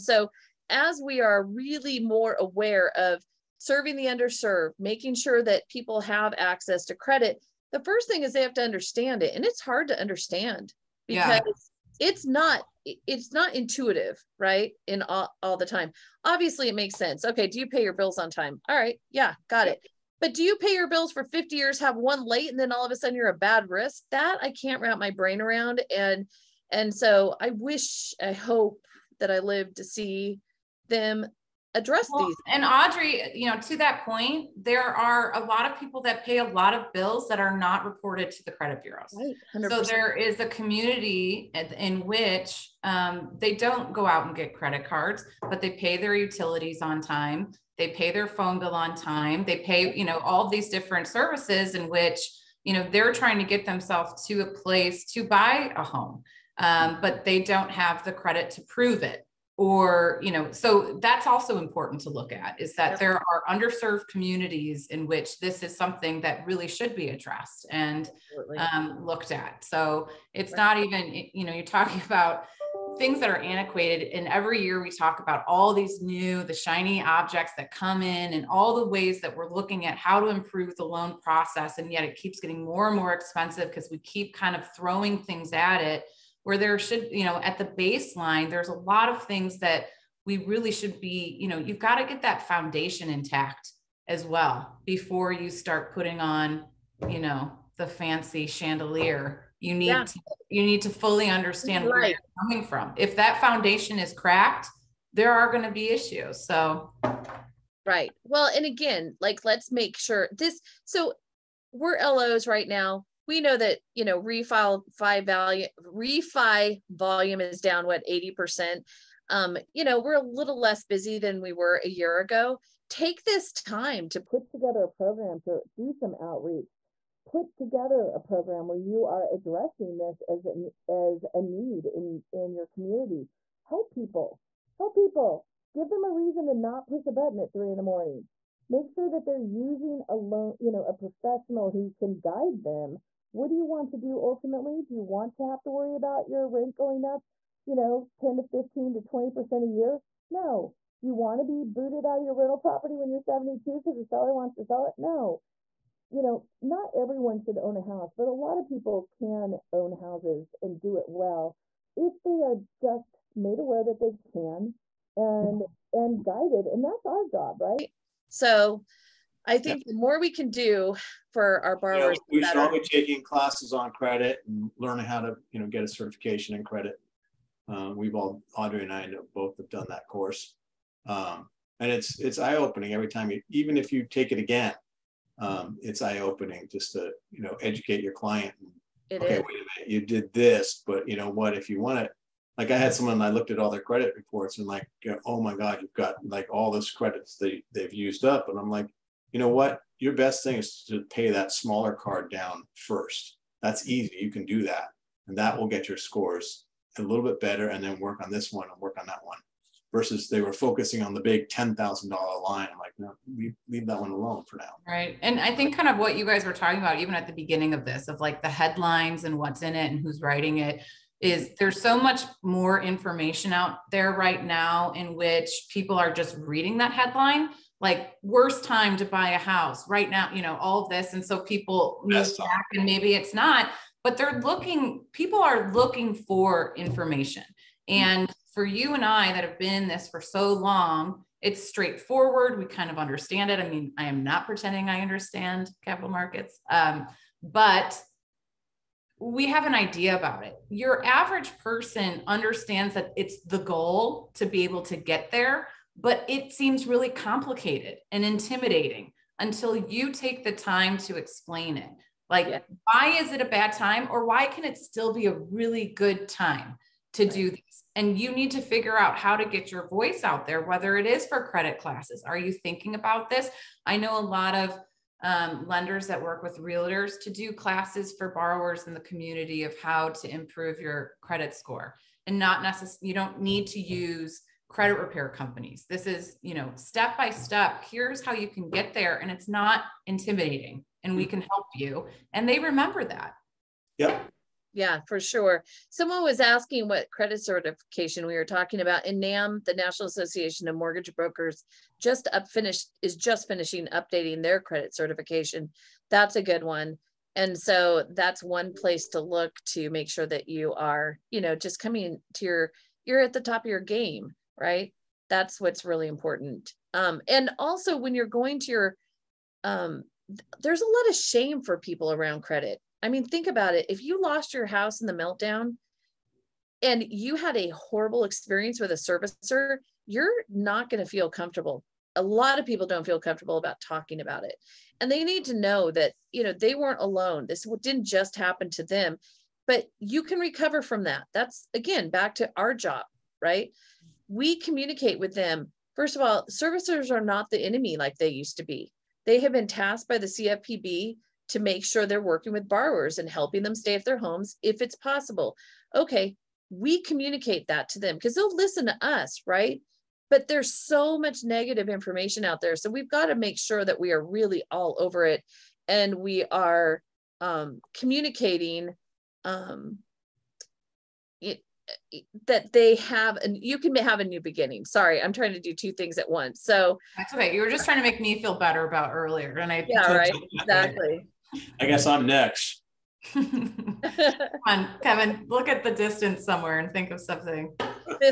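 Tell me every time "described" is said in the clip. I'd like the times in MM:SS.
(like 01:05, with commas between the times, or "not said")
not said.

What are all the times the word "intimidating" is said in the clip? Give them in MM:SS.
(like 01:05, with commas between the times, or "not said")
04:18, 04:50.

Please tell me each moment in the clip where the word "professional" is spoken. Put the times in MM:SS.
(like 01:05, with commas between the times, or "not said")
02:20.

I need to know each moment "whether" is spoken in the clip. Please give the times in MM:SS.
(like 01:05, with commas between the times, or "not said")
04:30.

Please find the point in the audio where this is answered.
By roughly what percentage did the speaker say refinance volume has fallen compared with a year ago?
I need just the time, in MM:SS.
01:58.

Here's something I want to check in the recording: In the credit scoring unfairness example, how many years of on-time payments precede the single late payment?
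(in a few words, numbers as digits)
50.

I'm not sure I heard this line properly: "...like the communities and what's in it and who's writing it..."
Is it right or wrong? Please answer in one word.
wrong.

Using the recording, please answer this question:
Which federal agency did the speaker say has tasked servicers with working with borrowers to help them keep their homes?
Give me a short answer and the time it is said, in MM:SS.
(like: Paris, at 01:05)
CFPB, at 05:50.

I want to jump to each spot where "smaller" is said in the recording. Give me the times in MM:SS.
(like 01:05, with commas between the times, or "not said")
03:21.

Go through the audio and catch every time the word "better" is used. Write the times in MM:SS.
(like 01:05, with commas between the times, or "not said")
03:27, 06:18.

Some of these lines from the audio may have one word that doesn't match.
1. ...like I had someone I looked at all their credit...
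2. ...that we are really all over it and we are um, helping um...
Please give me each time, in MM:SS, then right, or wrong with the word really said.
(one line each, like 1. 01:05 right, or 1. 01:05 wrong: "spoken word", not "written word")
1. 03:12 right
2. 06:03 wrong: "communicating", not "helping".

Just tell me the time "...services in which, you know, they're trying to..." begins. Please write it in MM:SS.
00:51.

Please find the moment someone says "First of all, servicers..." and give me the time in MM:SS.
05:45.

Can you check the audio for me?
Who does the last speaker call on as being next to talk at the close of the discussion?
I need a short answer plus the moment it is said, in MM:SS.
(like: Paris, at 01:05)
Kevin, at 06:25.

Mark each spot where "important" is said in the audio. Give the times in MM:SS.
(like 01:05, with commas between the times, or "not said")
01:01, 05:16.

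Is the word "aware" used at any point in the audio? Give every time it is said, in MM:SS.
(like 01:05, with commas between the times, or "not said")
00:02, 02:43.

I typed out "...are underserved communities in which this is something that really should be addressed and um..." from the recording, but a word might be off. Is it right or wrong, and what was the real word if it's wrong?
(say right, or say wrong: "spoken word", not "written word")
right.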